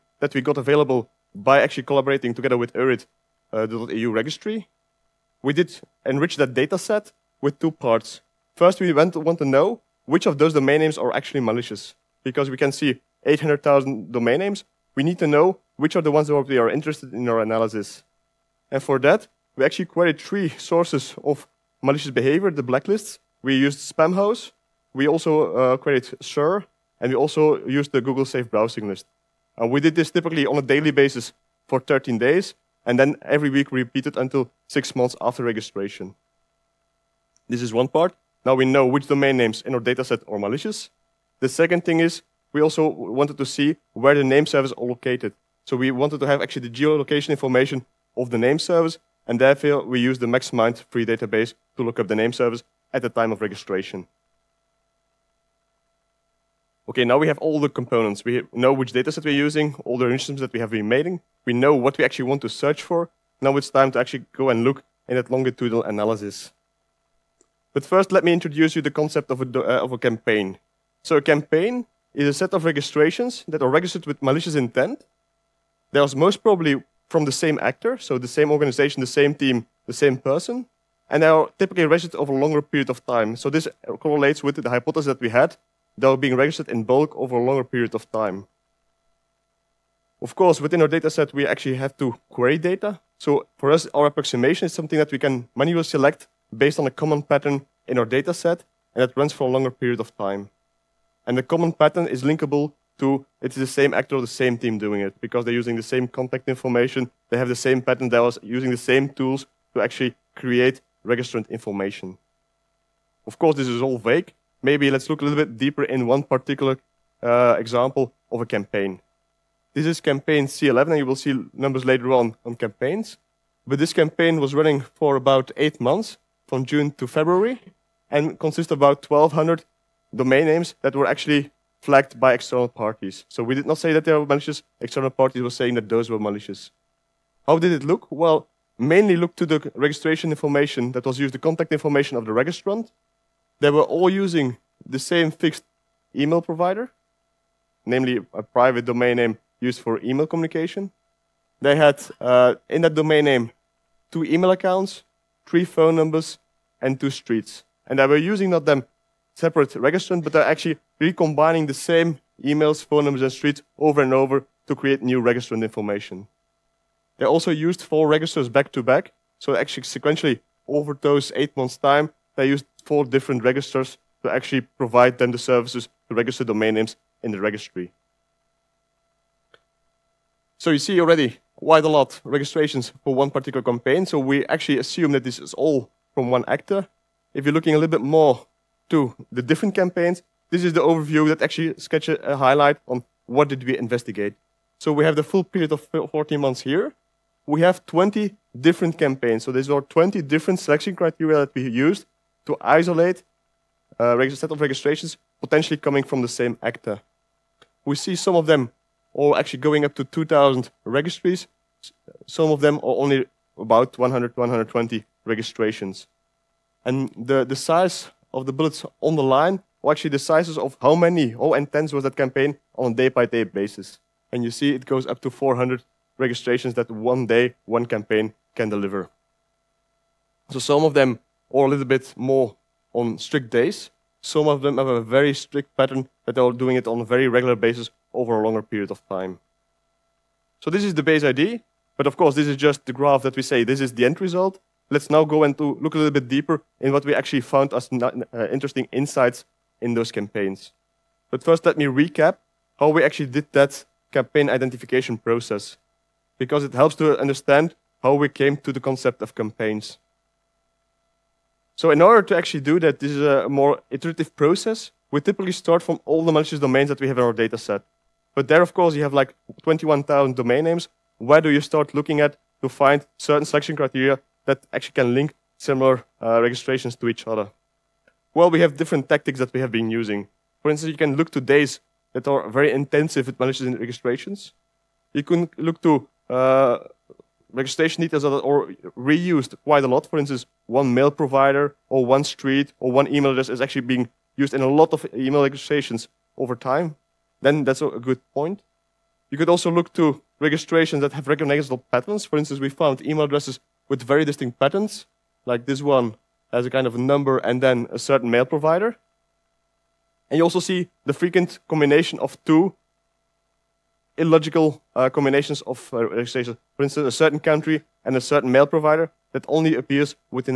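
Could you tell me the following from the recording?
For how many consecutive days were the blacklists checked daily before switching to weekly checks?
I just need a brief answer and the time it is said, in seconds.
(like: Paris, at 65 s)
13, at 31 s.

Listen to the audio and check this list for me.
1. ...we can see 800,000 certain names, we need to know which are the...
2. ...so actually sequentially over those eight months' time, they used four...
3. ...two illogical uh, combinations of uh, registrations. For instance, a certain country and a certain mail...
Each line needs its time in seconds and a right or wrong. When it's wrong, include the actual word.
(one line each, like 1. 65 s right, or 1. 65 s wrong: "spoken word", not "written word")
1. 12 s wrong: "domain", not "certain"
2. 169 s right
3. 312 s right.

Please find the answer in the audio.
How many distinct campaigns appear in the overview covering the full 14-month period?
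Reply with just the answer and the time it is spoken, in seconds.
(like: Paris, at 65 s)
20, at 197 s.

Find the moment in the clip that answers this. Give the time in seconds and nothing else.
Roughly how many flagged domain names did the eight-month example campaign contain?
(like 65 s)
129 s.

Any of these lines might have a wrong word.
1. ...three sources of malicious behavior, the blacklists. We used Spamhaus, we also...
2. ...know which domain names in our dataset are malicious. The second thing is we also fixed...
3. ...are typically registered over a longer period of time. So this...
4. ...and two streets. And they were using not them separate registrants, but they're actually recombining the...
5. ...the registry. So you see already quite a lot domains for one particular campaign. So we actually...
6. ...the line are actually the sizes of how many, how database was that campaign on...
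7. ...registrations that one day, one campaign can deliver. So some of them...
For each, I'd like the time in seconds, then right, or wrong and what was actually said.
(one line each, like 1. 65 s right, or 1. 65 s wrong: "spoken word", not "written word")
1. 20 s right
2. 38 s wrong: "wanted", not "fixed"
3. 81 s right
4. 156 s right
5. 177 s wrong: "registrations", not "domains"
6. 219 s wrong: "intense", not "database"
7. 226 s right.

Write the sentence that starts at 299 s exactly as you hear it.
You could also look to registrations that have recognizable patterns.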